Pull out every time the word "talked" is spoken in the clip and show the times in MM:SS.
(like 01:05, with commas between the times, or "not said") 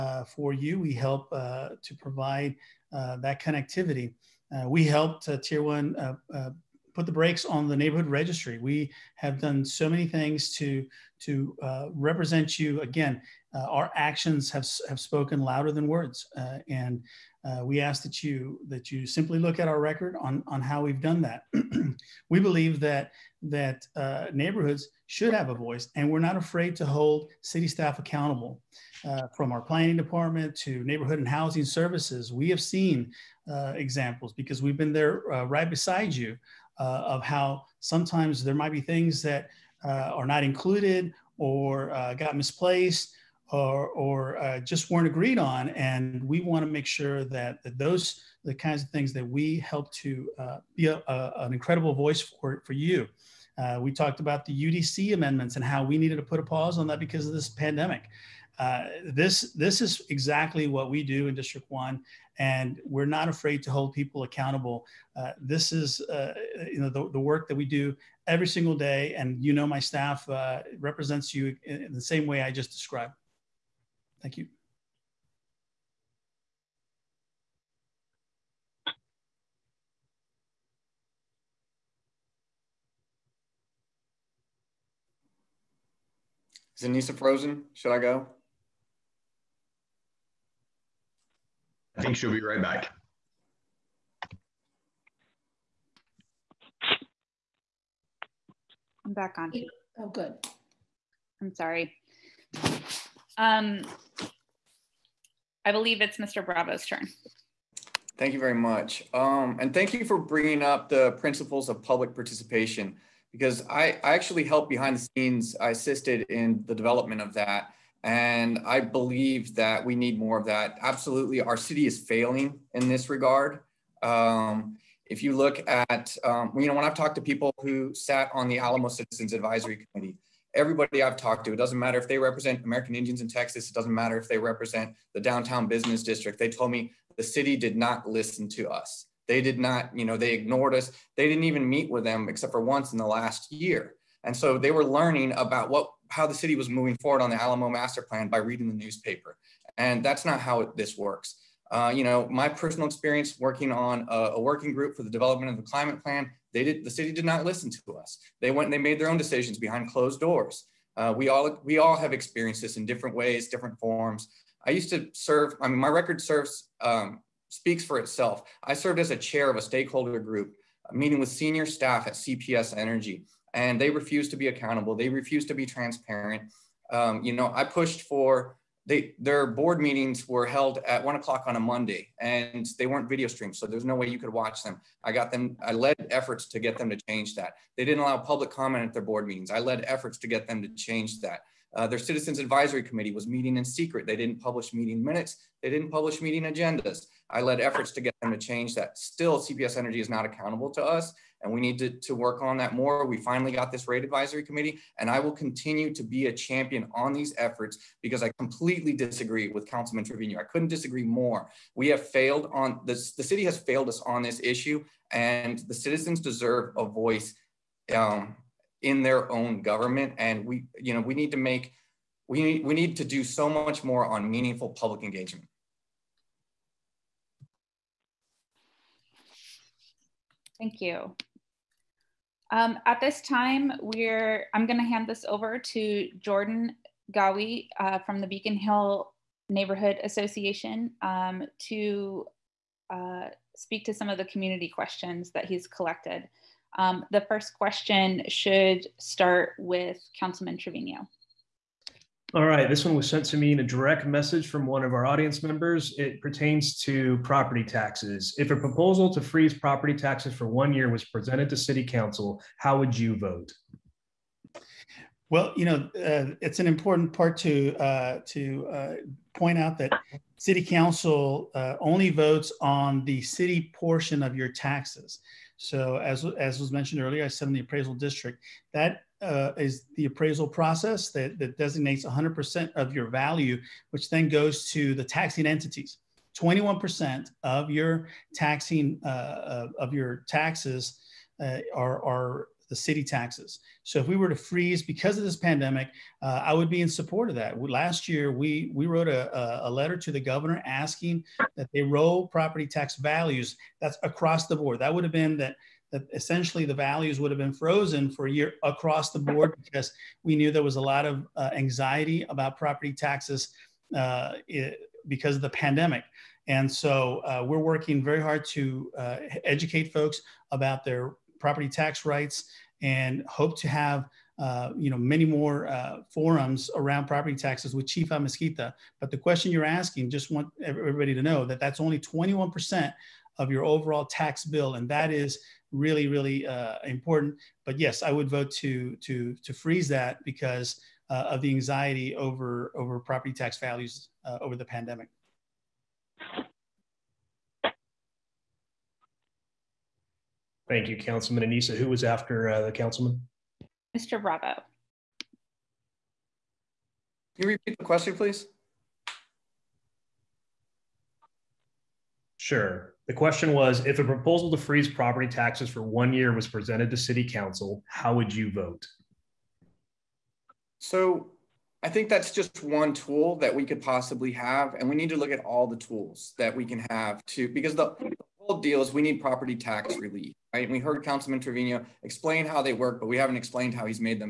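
00:53, 02:06, 02:11.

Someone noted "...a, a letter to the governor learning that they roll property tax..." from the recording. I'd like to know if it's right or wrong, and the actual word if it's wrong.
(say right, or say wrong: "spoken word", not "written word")
wrong: "asking", not "learning".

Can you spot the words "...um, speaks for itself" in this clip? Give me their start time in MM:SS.
02:46.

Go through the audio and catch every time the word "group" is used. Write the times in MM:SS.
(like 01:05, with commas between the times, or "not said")
02:34, 02:50.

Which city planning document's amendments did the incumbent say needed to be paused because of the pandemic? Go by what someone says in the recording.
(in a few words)
UDC amendments.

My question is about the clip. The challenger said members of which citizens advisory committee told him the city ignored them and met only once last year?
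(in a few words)
Alamo Citizens Advisory Committee.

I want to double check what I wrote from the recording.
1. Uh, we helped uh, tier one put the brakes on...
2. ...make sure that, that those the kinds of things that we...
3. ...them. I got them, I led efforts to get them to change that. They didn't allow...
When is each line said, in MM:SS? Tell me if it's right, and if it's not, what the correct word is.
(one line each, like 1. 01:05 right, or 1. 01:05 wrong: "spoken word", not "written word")
1. 00:04 right
2. 00:46 right
3. 03:04 right.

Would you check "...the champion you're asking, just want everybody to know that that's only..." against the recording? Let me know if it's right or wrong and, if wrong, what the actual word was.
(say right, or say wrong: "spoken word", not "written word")
wrong: "question", not "champion".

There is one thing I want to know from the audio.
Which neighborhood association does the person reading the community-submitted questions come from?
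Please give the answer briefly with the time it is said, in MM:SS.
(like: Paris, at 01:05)
Beacon Hill, at 03:58.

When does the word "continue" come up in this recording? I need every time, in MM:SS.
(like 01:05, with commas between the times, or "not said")
03:25.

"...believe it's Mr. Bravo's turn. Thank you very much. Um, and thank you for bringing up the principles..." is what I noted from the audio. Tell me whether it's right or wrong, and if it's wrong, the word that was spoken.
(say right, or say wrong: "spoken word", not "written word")
right.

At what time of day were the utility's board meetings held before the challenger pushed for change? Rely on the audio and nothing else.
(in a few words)
1 o'clock.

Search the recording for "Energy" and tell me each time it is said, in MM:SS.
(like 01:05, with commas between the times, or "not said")
02:52, 03:19.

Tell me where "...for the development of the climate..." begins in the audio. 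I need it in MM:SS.
02:34.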